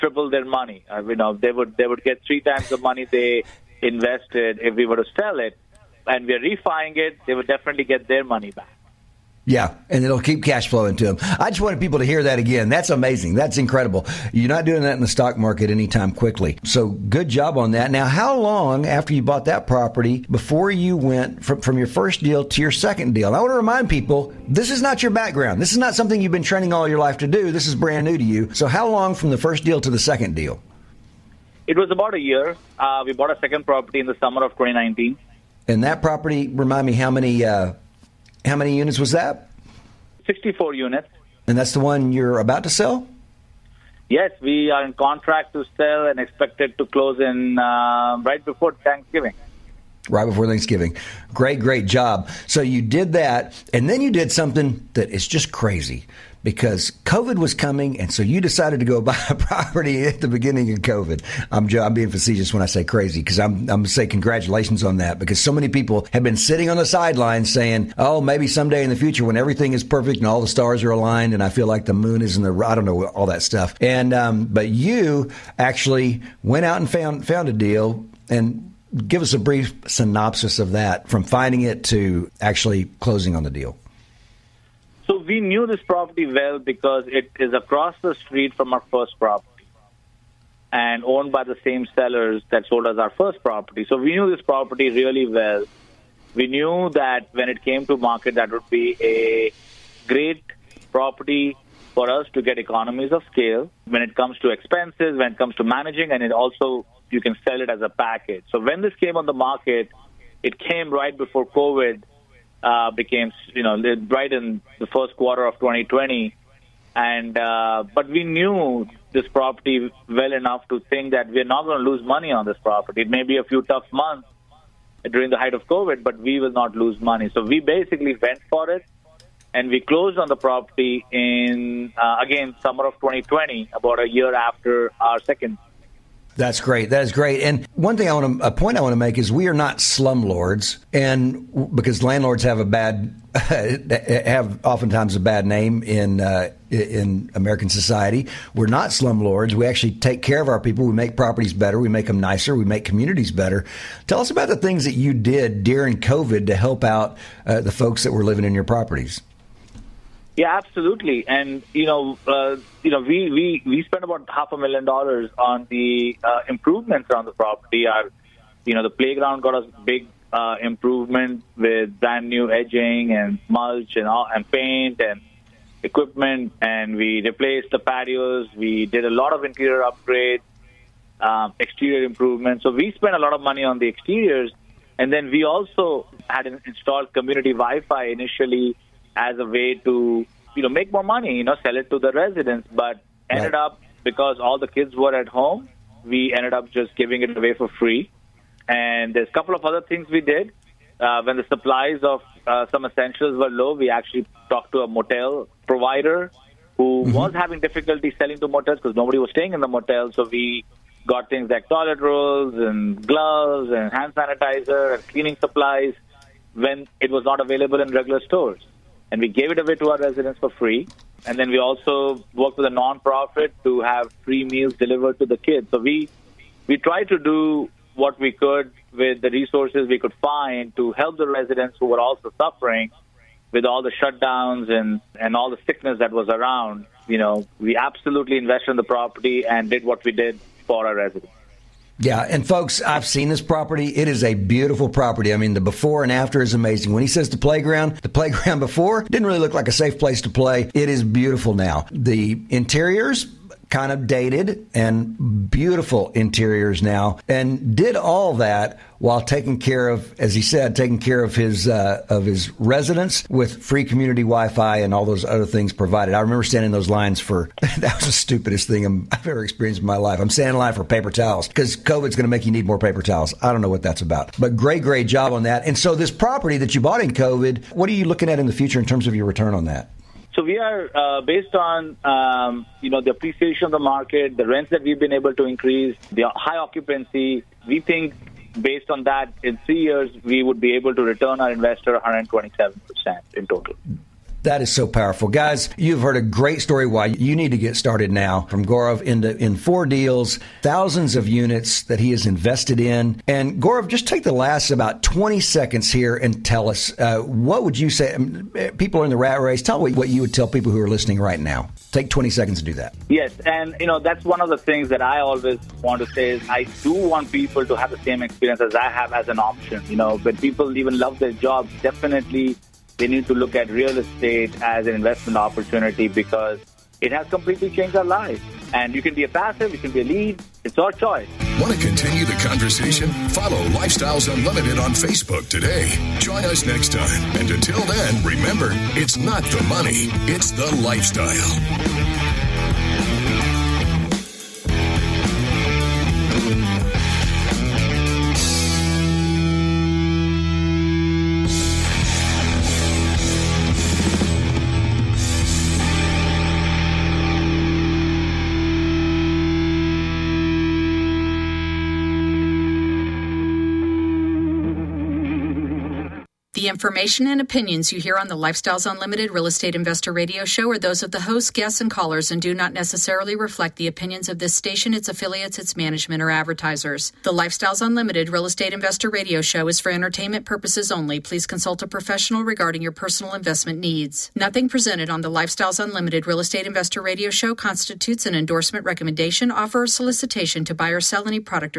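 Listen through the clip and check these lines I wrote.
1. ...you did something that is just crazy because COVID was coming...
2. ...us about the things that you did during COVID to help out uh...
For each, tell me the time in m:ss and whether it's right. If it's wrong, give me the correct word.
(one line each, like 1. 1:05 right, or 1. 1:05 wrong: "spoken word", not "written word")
1. 0:54 right
2. 2:34 right.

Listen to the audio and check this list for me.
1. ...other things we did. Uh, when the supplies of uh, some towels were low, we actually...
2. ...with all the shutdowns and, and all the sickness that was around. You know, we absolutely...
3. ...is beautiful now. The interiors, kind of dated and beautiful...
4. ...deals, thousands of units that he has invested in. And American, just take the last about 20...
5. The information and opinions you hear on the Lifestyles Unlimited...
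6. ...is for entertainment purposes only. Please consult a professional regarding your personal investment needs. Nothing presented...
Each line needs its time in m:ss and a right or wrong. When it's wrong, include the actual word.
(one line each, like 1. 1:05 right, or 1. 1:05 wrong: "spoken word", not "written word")
1. 3:19 wrong: "essentials", not "towels"
2. 3:53 right
3. 4:10 right
4. 4:59 wrong: "Gaurav", not "American"
5. 6:06 right
6. 6:19 right.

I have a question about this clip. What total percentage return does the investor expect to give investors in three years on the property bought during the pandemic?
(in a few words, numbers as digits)
127 percent.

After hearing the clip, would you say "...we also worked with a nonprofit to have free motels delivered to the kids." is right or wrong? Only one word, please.
wrong.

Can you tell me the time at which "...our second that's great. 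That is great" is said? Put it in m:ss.
2:14.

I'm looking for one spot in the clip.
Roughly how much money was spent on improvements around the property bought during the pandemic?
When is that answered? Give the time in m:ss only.
2:44.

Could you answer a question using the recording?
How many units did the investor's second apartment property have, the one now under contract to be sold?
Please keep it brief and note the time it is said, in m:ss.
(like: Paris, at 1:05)
64, at 0:40.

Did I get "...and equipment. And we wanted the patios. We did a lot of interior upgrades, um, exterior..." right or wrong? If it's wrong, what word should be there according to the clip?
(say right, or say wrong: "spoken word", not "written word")
wrong: "replaced", not "wanted".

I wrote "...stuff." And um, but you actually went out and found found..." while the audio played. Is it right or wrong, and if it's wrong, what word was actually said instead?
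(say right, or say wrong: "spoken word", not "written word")
right.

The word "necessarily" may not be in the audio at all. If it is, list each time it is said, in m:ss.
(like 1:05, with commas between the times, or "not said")
6:12.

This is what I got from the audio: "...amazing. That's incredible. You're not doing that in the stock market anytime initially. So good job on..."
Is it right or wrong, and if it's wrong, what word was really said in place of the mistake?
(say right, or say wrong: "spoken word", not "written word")
wrong: "quickly", not "initially".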